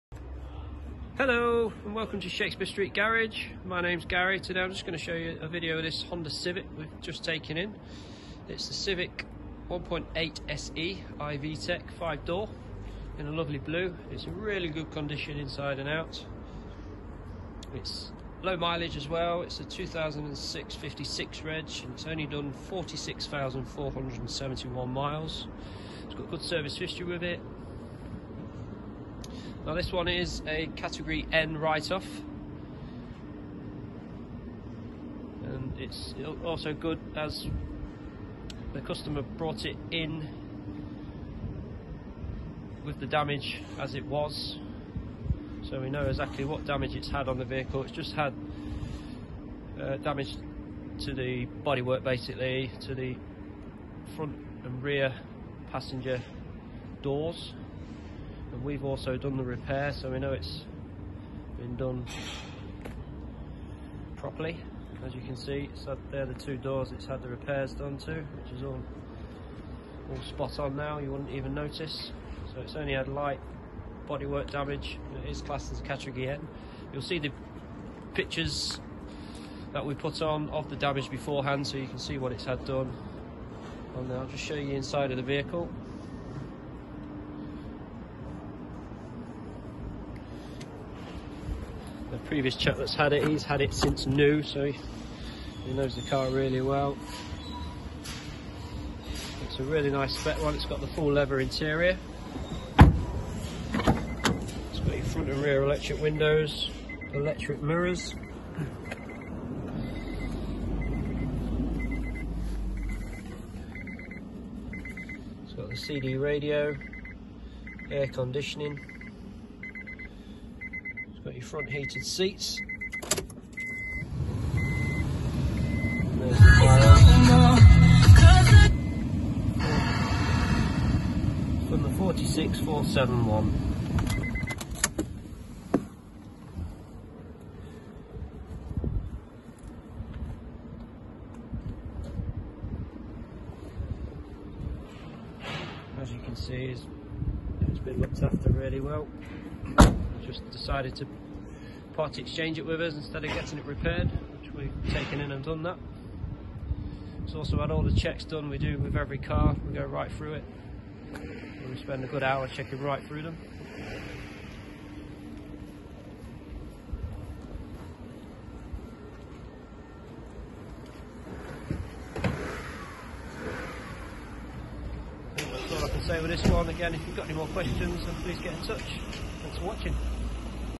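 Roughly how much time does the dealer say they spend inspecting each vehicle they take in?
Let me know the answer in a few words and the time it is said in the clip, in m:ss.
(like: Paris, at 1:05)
A good hour, at 2:42.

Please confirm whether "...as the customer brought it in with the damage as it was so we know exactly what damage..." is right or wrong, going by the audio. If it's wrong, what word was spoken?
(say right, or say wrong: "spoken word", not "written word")
right.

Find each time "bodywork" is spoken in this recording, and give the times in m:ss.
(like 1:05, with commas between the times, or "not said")
0:51, 1:14.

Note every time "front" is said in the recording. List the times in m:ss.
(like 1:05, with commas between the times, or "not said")
0:54, 1:45, 2:01.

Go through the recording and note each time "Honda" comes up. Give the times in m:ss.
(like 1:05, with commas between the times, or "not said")
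0:06.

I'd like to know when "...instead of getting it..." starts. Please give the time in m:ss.
2:32.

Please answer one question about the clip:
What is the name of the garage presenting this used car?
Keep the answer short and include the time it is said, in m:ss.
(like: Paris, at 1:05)
Shakespeare Street Garage, at 0:02.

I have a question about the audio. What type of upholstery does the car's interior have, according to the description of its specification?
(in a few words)
Full leather.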